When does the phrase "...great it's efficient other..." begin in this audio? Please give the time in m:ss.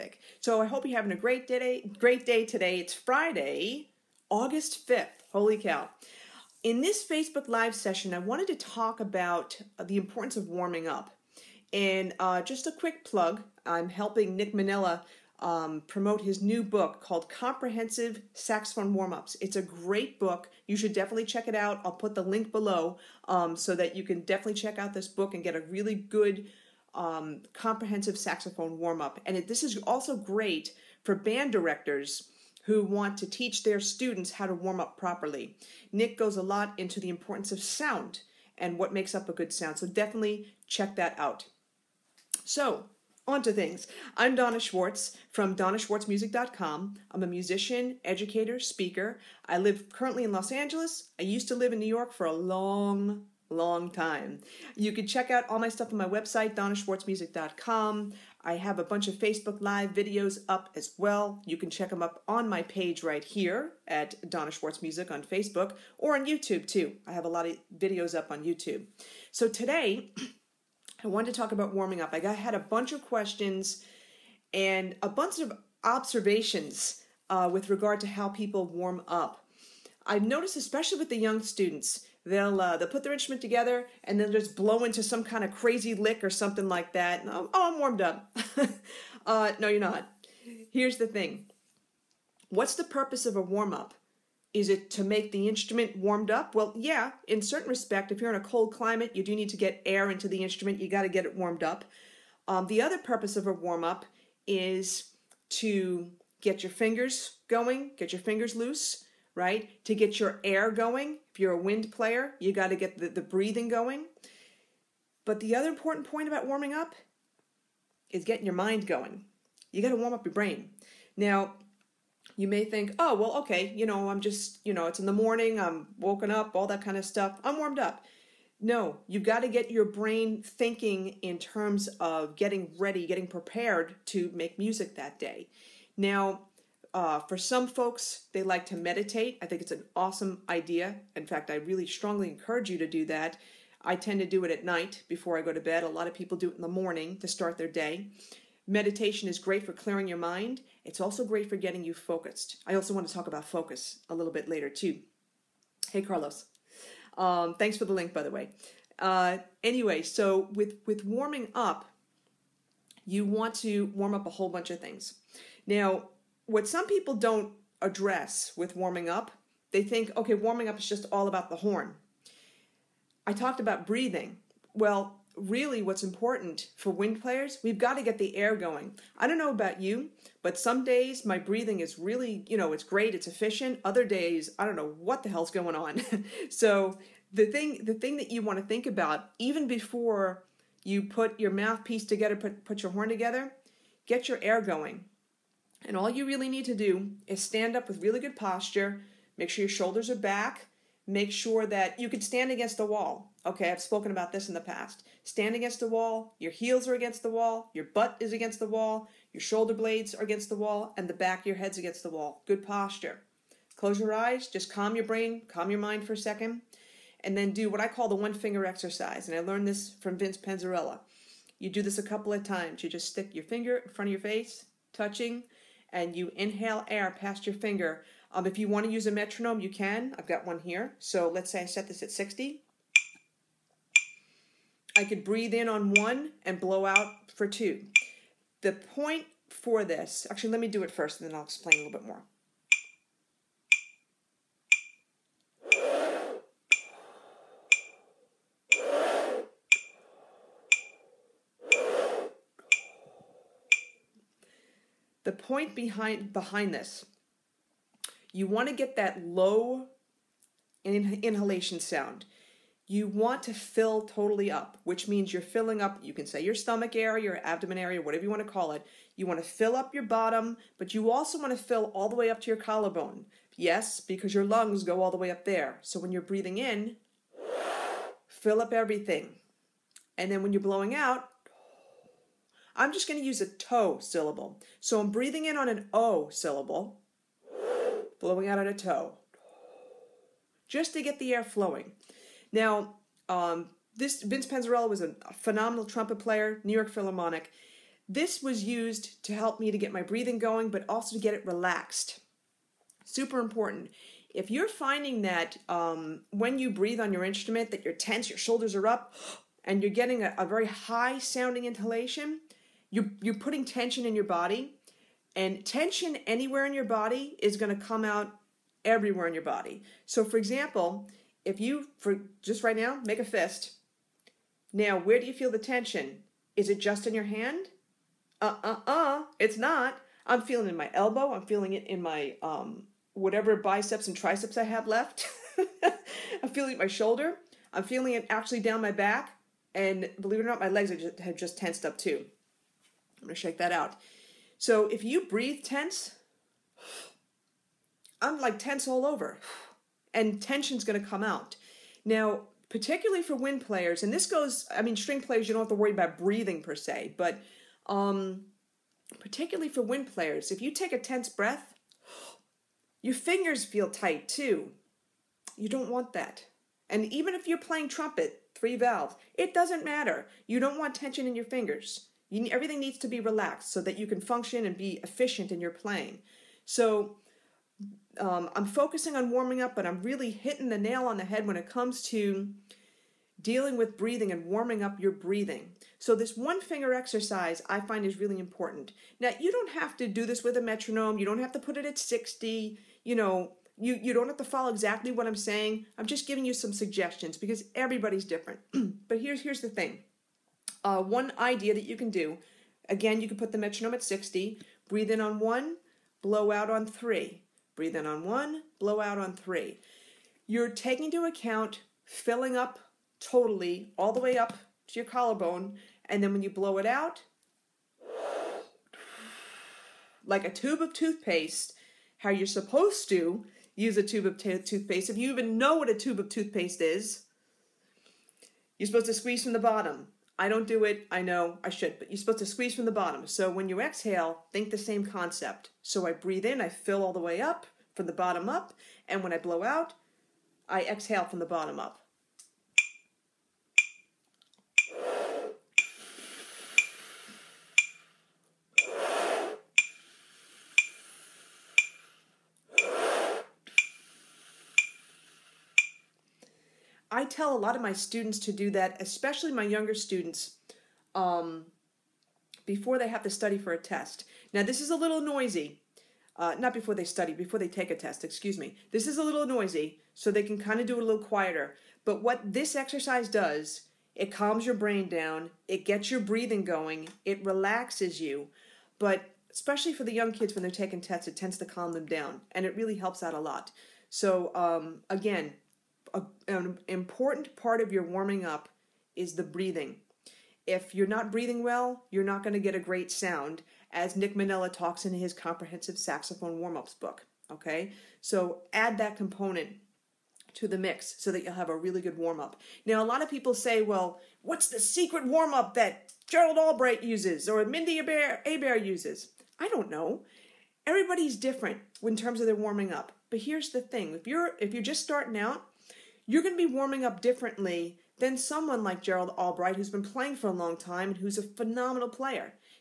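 3:02.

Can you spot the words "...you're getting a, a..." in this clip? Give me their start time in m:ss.
5:09.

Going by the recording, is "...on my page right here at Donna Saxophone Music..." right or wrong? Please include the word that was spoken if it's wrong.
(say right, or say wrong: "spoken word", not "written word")
wrong: "Schwartz", not "Saxophone".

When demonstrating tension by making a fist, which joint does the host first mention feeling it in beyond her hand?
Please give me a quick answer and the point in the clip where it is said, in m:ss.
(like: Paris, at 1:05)
Elbow, at 5:30.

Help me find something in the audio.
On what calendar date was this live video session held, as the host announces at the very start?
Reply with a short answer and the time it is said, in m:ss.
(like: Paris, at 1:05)
August 5th, at 0:04.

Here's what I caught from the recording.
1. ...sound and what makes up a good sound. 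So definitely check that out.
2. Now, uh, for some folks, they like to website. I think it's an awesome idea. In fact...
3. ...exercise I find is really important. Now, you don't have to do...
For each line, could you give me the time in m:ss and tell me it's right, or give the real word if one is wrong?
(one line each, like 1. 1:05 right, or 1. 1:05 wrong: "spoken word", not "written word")
1. 0:37 right
2. 2:15 wrong: "meditate", not "website"
3. 6:26 right.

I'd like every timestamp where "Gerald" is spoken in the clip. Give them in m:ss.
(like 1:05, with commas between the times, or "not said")
8:26, 8:39.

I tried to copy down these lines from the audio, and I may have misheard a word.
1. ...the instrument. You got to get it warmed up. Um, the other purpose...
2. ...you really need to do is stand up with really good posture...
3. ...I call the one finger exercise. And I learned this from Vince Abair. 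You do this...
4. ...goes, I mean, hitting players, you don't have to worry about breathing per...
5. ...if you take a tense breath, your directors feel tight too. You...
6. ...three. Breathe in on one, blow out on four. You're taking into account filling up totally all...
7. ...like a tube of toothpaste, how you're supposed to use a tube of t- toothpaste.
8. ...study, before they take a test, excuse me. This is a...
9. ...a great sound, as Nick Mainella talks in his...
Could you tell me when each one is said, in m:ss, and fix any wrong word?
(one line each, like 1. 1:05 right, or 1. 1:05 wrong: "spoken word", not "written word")
1. 1:40 right
2. 3:16 right
3. 3:37 wrong: "Penzarella", not "Abair"
4. 5:54 wrong: "string", not "hitting"
5. 6:00 wrong: "fingers", not "directors"
6. 6:46 wrong: "three", not "four"
7. 7:00 right
8. 7:47 right
9. 8:12 right.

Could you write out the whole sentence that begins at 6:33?
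You, you don't have to follow exactly what I'm saying.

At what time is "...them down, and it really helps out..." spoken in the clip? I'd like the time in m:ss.
8:01.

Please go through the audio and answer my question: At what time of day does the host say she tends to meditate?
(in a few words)
At night.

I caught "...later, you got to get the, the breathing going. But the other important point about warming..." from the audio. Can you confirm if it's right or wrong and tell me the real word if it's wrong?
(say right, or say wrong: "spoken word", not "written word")
wrong: "player", not "later".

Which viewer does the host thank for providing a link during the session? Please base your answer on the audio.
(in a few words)
Carlos.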